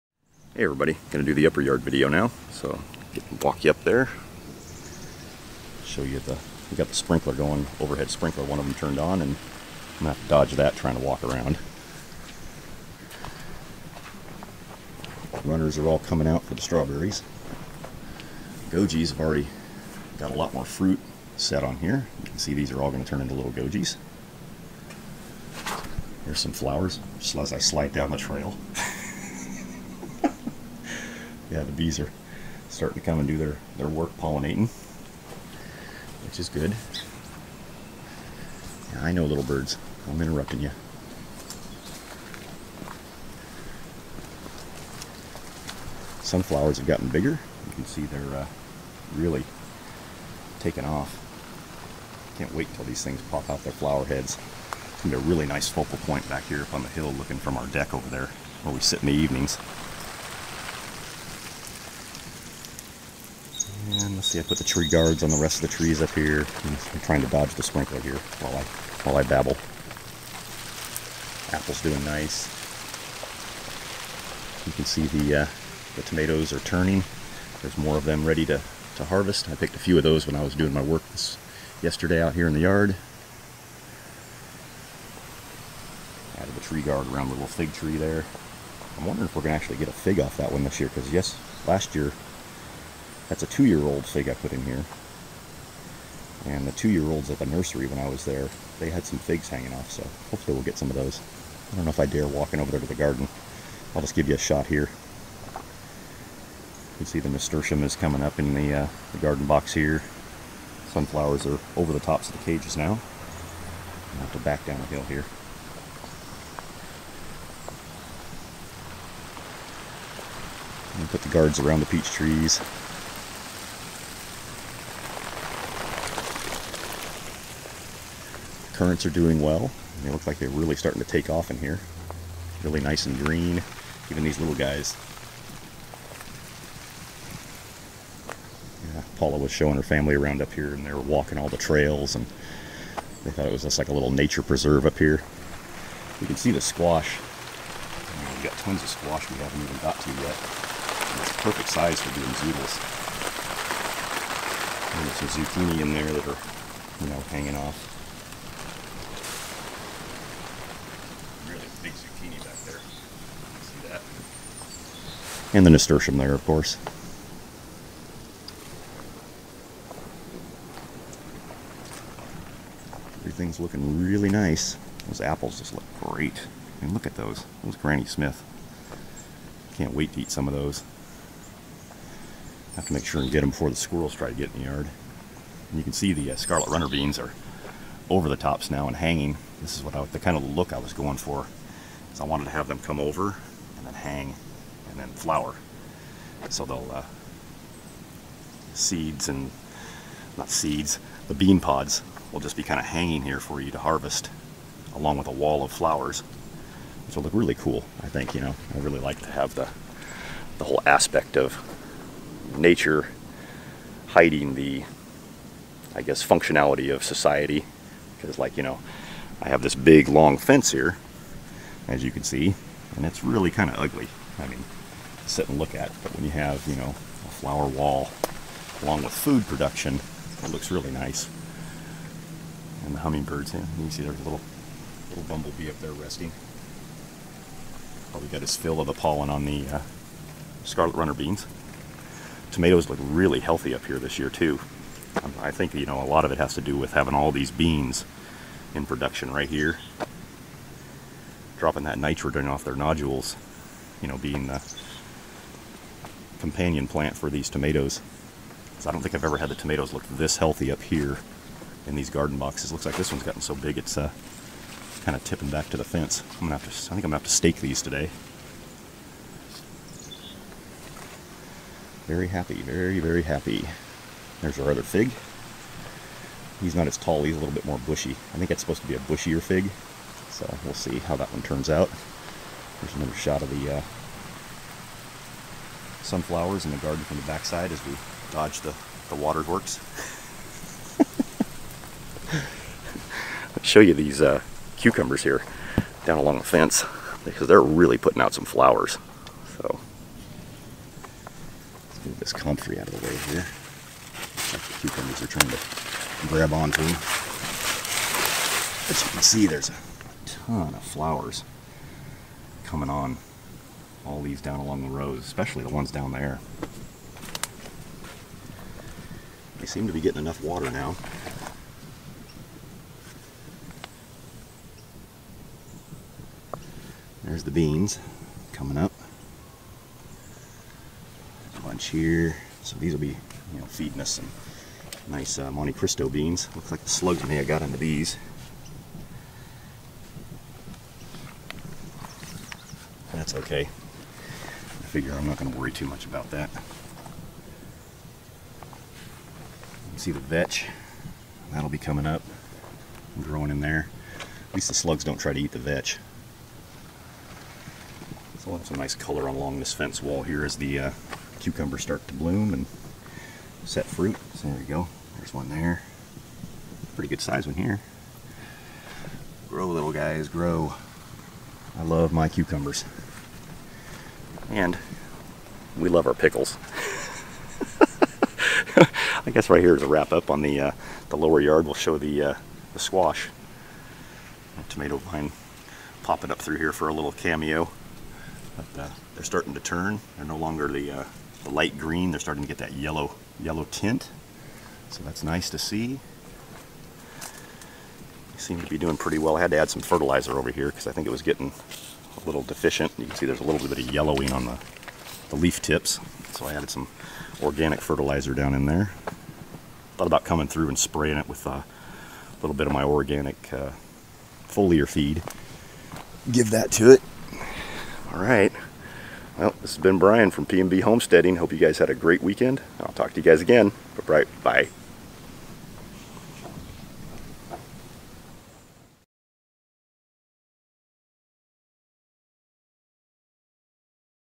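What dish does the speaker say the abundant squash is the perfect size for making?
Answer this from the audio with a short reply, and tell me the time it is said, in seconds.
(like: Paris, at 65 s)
Zoodles, at 152 s.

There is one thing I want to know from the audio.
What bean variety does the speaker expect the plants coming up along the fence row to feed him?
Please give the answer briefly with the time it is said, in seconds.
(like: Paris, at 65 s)
Monte Cristo, at 335 s.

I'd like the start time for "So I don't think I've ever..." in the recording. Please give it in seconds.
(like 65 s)
258 s.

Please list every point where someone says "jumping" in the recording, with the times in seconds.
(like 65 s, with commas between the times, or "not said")
not said.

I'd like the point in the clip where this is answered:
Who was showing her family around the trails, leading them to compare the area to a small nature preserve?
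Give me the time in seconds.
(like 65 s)
139 s.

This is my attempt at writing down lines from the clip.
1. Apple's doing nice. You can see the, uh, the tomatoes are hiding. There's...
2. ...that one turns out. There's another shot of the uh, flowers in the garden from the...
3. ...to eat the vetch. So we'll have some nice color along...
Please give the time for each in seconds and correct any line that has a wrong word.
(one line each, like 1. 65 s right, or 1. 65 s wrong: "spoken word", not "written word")
1. 71 s wrong: "turning", not "hiding"
2. 281 s wrong: "sunflowers", not "flowers"
3. 355 s right.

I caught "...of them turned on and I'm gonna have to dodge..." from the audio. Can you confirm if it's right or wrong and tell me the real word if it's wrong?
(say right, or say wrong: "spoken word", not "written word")
right.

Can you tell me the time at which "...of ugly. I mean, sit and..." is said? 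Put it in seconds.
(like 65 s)
223 s.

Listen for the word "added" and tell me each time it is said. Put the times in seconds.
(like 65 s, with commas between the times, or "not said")
86 s, 406 s.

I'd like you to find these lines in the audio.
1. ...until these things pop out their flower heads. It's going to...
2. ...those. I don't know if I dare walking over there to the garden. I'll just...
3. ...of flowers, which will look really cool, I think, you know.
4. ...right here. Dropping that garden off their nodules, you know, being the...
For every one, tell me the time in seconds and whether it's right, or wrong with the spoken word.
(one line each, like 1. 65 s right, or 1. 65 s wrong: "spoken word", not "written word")
1. 52 s right
2. 100 s right
3. 205 s right
4. 249 s wrong: "nitrogen", not "garden".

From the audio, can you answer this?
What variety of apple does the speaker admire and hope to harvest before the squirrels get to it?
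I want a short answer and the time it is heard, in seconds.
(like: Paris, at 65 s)
Granny Smith, at 177 s.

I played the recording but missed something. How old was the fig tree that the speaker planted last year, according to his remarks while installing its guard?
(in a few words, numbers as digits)
2 years old.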